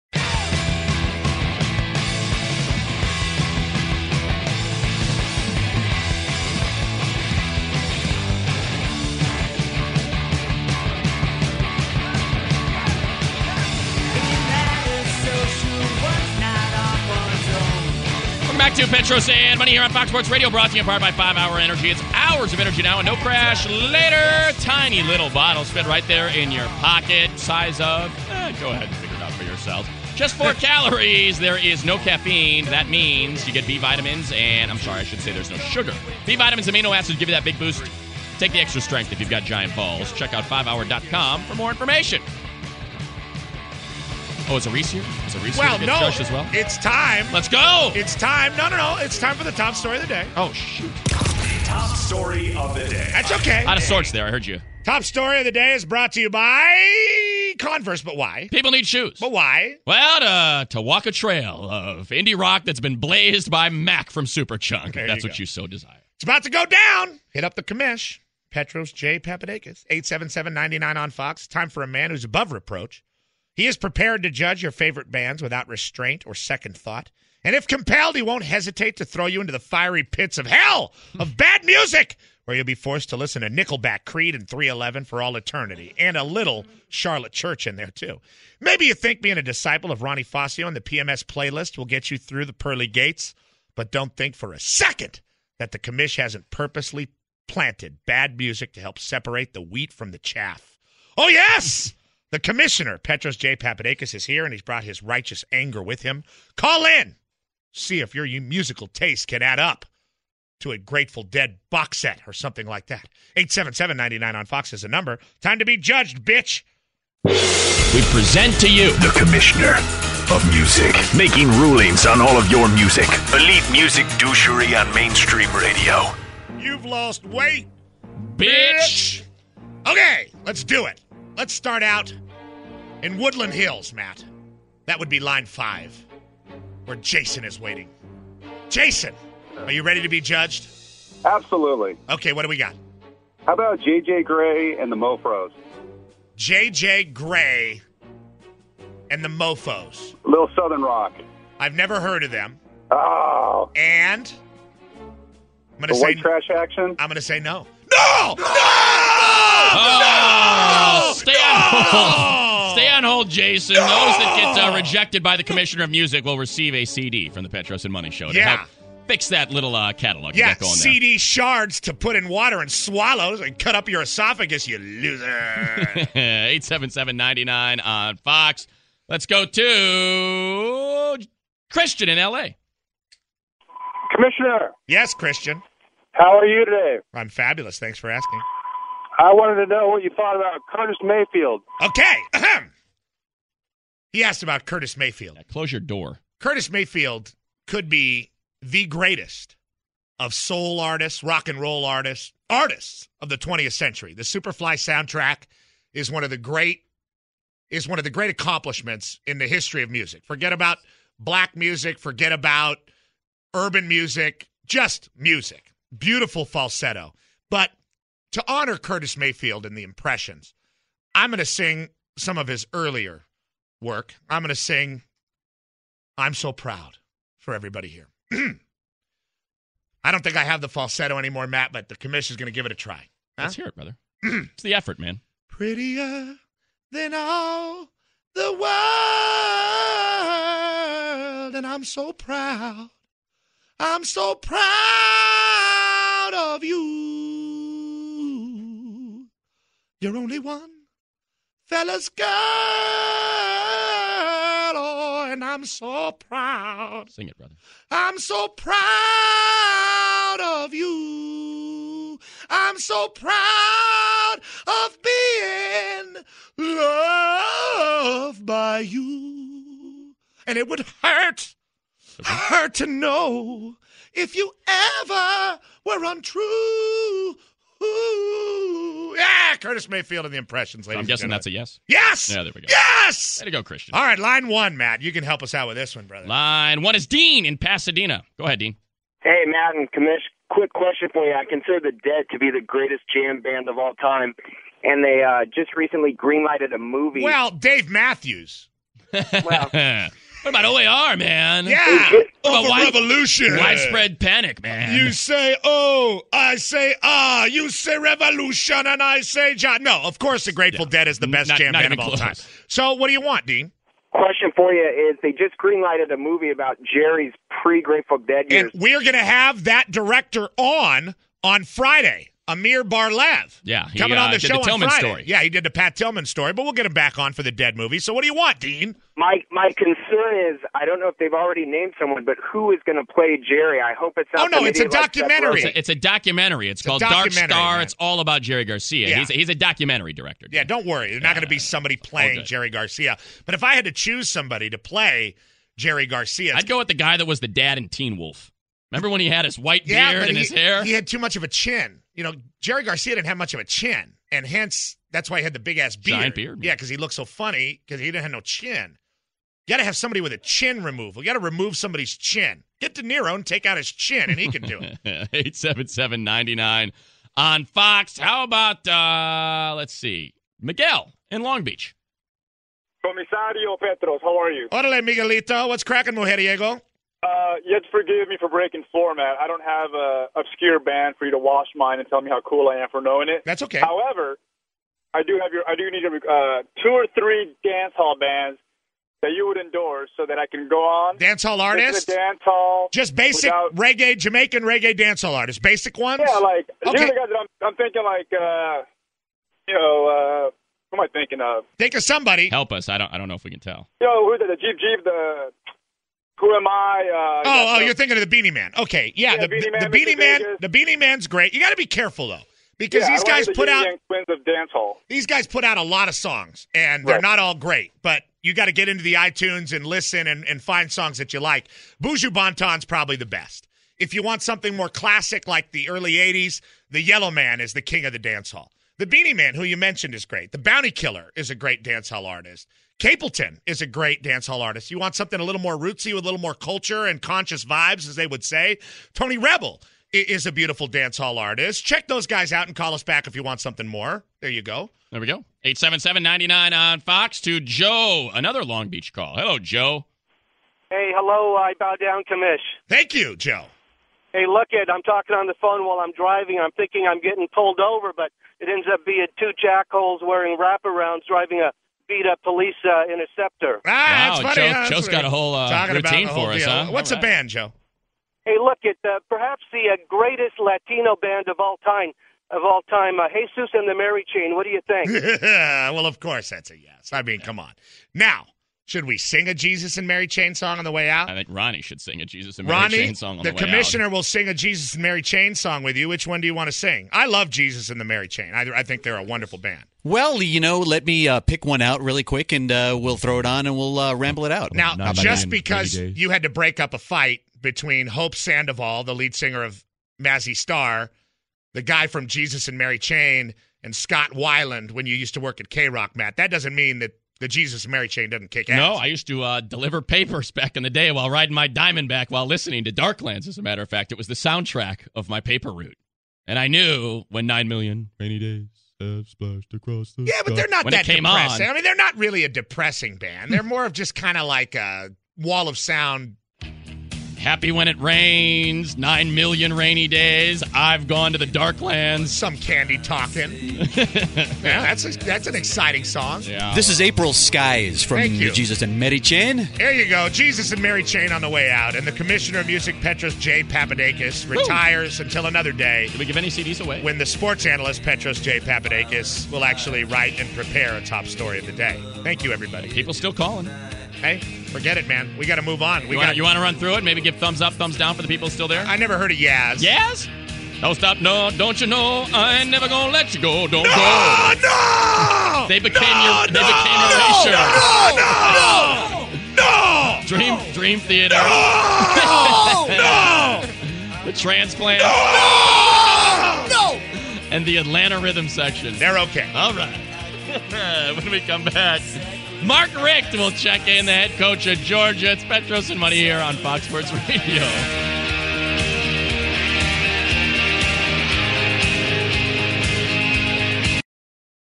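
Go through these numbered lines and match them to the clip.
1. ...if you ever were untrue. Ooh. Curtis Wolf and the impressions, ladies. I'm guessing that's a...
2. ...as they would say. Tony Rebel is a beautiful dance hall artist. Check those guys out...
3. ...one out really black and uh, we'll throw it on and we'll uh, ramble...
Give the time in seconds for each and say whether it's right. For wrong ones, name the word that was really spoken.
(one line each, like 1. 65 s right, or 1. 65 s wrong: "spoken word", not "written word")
1. 274 s wrong: "Mayfield", not "Wolf"
2. 438 s right
3. 491 s wrong: "quick", not "black".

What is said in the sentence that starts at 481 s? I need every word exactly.
I think Ronnie should sing a Jesus and Ronnie, Mary Chain song on the, the way out.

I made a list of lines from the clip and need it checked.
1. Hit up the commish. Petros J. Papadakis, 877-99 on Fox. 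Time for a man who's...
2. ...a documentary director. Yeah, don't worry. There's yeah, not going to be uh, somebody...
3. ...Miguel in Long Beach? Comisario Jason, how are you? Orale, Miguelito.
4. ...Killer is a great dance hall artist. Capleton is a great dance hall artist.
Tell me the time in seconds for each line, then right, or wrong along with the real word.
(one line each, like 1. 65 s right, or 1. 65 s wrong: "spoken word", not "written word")
1. 67 s right
2. 339 s right
3. 370 s wrong: "Petros", not "Jason"
4. 430 s right.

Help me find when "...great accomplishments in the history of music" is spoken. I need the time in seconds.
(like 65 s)
208 s.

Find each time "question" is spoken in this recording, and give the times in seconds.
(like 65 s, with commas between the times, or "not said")
290 s, 314 s.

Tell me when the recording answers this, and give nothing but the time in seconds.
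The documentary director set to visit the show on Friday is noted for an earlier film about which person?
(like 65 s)
325 s.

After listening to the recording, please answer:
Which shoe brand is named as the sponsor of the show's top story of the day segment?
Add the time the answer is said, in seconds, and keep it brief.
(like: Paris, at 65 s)
Converse, at 57 s.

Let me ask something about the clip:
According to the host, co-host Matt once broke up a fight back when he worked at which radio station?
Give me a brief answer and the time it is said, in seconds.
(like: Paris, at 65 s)
K Rock, at 505 s.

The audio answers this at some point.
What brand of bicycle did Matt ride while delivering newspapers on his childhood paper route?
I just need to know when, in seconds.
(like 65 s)
511 s.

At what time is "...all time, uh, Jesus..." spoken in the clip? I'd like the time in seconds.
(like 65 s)
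472 s.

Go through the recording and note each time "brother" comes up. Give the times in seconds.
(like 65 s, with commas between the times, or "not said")
233 s, 257 s, 286 s.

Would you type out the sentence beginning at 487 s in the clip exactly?
I love Jesus and the Mary Chain.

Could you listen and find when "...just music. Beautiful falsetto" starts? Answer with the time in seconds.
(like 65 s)
214 s.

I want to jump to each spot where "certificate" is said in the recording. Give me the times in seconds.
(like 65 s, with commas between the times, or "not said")
not said.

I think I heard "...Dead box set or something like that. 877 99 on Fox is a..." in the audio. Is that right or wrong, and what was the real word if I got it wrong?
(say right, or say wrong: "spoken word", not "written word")
right.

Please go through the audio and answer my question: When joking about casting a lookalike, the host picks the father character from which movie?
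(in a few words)
Teen Wolf.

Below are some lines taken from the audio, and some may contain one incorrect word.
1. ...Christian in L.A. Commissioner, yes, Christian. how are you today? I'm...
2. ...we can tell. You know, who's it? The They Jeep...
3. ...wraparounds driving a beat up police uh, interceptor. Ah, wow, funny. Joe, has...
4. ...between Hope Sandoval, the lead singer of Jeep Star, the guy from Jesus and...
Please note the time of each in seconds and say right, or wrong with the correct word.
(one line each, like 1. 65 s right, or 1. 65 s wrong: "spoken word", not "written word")
1. 181 s right
2. 403 s wrong: "Jeep", not "They"
3. 460 s right
4. 497 s wrong: "Mazzy", not "Jeep".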